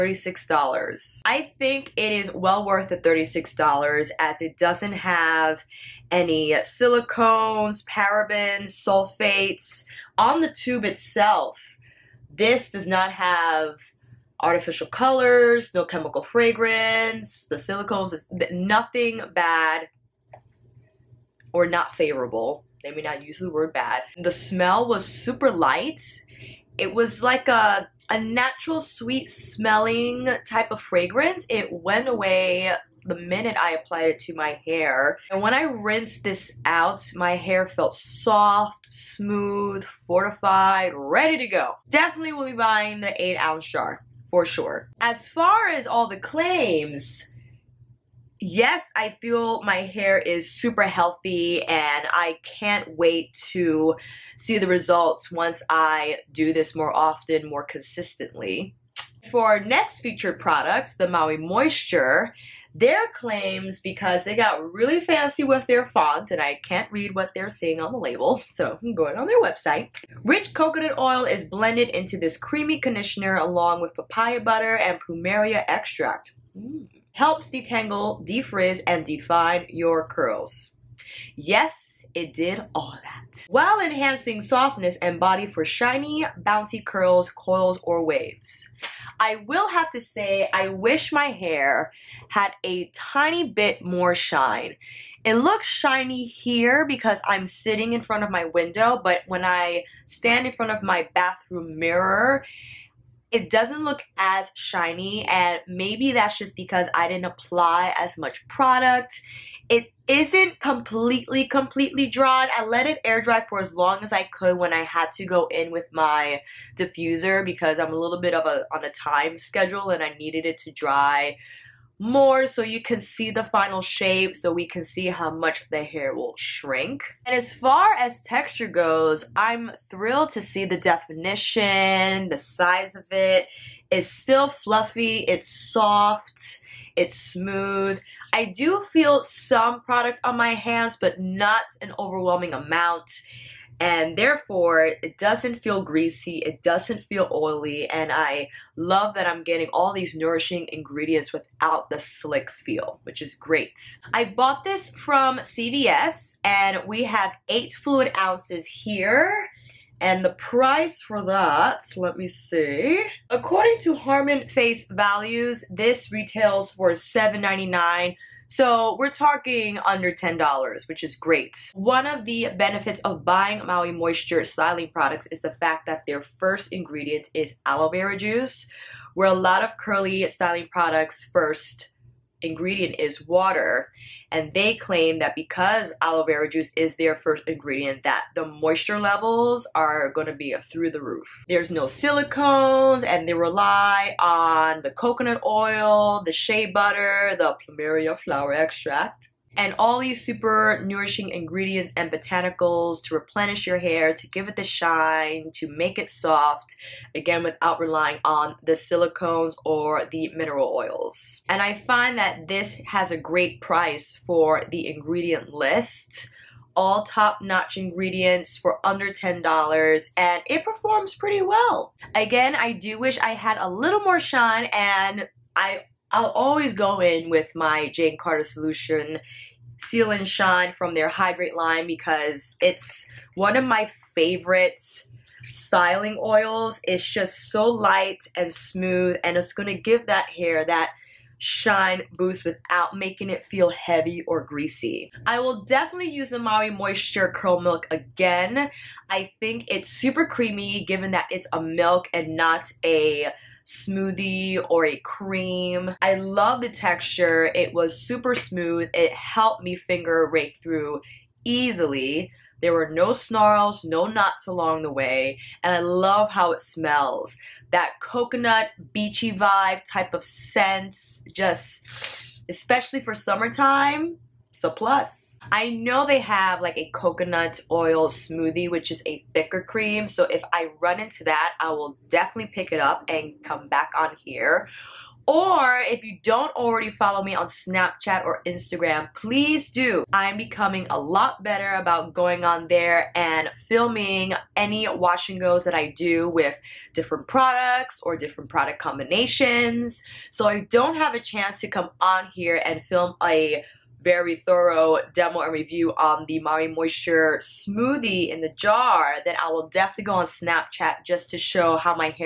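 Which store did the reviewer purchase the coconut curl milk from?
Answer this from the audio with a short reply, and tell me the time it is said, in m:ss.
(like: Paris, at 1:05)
CVS, at 2:35.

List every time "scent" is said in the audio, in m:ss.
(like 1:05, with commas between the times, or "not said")
4:30.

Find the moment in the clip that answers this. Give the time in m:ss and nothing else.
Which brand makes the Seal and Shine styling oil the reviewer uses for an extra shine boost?
3:47.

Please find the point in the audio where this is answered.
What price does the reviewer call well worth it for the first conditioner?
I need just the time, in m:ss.
0:02.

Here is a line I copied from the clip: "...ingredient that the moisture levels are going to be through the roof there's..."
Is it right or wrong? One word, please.
right.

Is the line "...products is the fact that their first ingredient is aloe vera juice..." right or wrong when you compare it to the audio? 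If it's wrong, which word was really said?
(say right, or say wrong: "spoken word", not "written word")
right.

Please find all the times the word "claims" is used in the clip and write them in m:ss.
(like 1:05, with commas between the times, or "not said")
0:46, 1:03, 3:04.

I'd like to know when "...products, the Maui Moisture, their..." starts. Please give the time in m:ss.
1:00.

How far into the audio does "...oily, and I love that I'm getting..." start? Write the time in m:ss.
2:27.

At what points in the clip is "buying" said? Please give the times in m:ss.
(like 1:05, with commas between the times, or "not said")
0:42, 2:53.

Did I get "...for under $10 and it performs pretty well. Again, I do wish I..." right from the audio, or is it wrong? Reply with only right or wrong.
right.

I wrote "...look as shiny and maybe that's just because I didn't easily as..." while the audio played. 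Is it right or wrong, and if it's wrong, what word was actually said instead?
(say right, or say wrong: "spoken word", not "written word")
wrong: "apply", not "easily".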